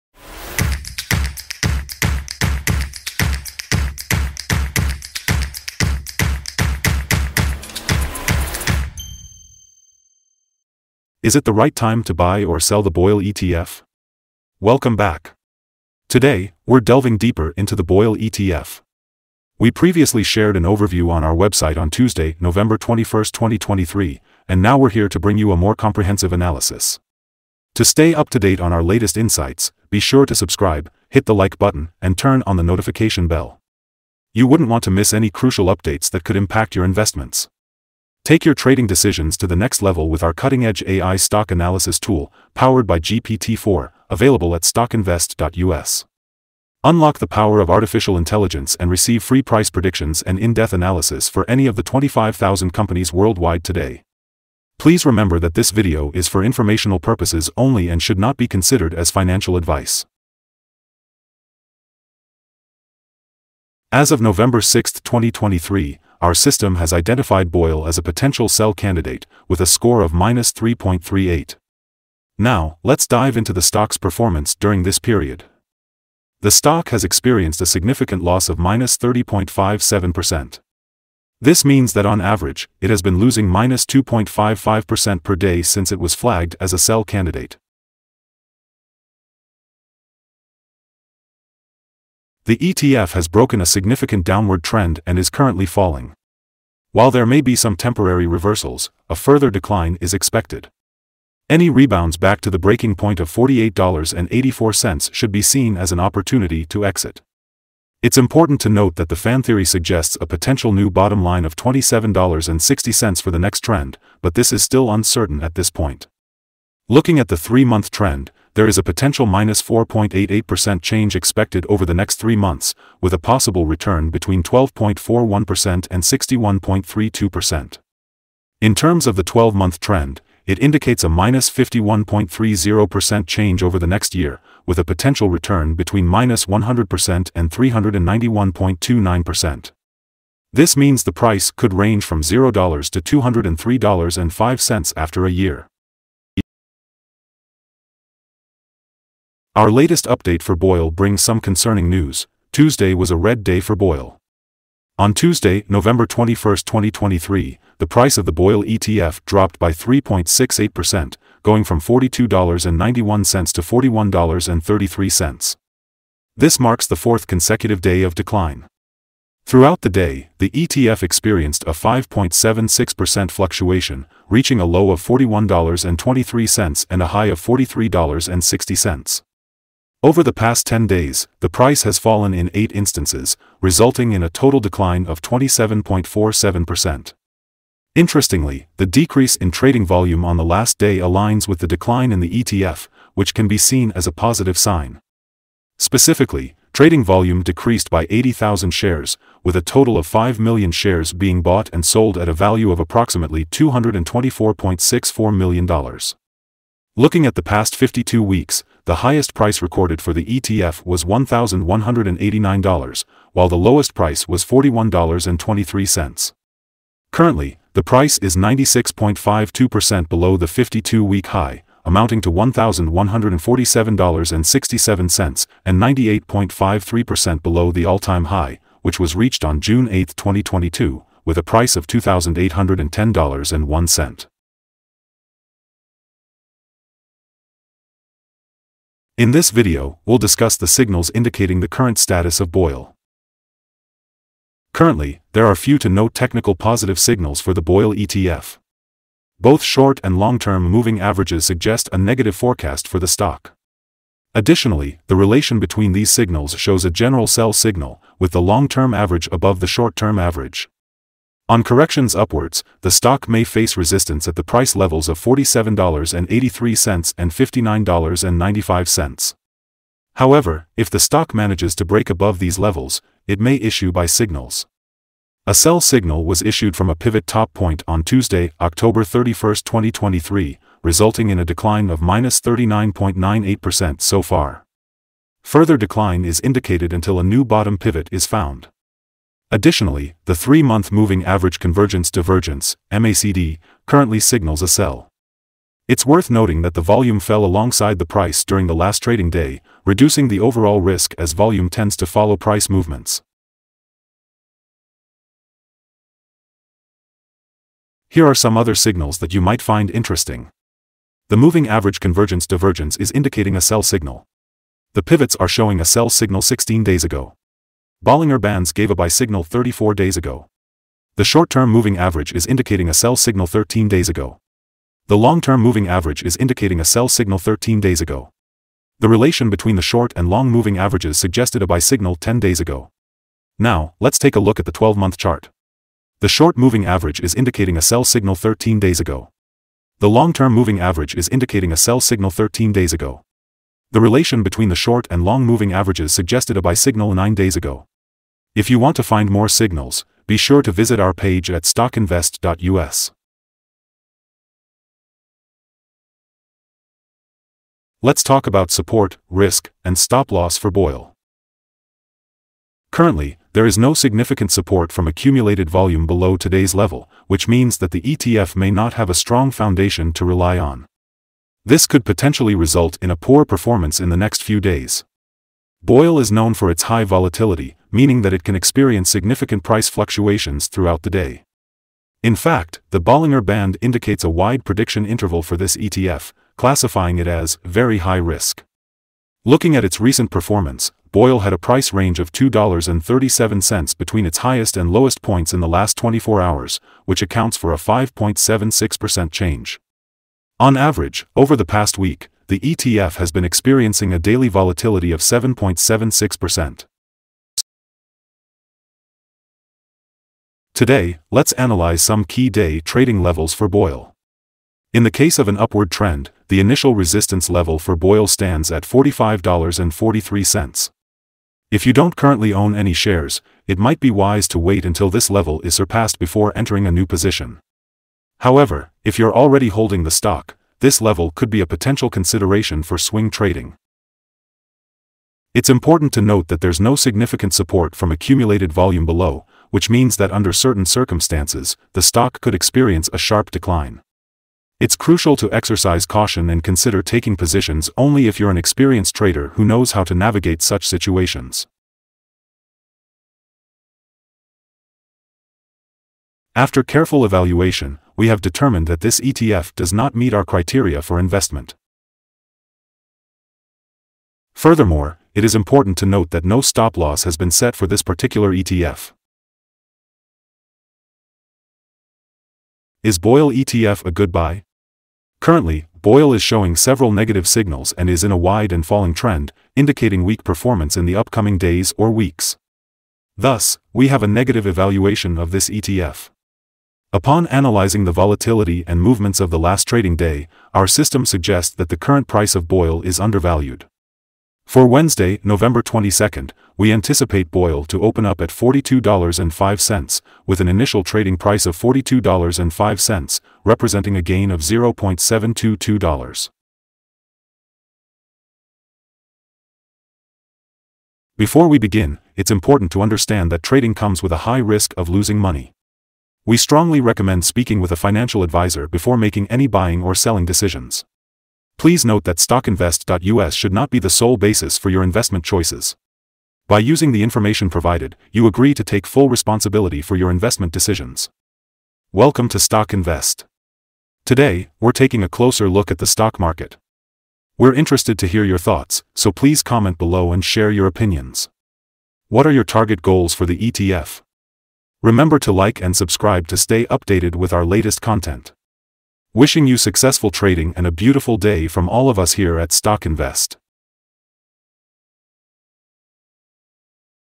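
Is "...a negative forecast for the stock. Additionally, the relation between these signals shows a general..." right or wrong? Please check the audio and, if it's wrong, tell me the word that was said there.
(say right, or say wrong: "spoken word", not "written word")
right.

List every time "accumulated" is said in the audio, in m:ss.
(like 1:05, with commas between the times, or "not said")
6:05, 7:18.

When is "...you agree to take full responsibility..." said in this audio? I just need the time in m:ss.
8:48.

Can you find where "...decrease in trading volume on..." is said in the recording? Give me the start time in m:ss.
3:08.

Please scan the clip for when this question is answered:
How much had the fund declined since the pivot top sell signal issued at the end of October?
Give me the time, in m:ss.
4:42.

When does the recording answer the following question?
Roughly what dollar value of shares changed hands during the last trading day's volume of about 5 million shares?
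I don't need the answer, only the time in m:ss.
3:23.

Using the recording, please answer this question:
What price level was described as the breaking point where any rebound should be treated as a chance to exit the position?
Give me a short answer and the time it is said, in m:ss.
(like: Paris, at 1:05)
$48.84, at 1:43.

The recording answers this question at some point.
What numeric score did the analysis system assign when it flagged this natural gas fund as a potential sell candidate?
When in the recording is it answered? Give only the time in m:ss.
1:10.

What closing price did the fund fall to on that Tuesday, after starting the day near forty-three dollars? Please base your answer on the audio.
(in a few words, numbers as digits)
$41.33.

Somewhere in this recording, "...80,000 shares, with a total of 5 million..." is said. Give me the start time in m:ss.
3:18.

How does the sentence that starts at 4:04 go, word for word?
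Currently, there are few to no technical positive signals for the boil ETF.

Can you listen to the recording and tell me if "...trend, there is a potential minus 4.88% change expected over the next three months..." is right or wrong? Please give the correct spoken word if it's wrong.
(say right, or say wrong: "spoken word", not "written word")
right.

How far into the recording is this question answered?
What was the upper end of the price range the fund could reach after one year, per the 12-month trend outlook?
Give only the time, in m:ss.
2:23.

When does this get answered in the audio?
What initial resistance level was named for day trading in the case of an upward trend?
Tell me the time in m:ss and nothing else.
6:58.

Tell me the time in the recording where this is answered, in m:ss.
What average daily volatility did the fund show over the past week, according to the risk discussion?
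6:45.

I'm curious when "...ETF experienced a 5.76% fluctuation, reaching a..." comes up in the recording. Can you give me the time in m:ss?
2:50.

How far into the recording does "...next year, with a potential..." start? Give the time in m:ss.
2:13.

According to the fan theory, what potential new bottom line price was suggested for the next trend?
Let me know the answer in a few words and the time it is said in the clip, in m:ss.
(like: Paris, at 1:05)
$27.60, at 1:51.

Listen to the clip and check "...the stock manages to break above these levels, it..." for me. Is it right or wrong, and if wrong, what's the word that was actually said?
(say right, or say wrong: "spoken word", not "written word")
right.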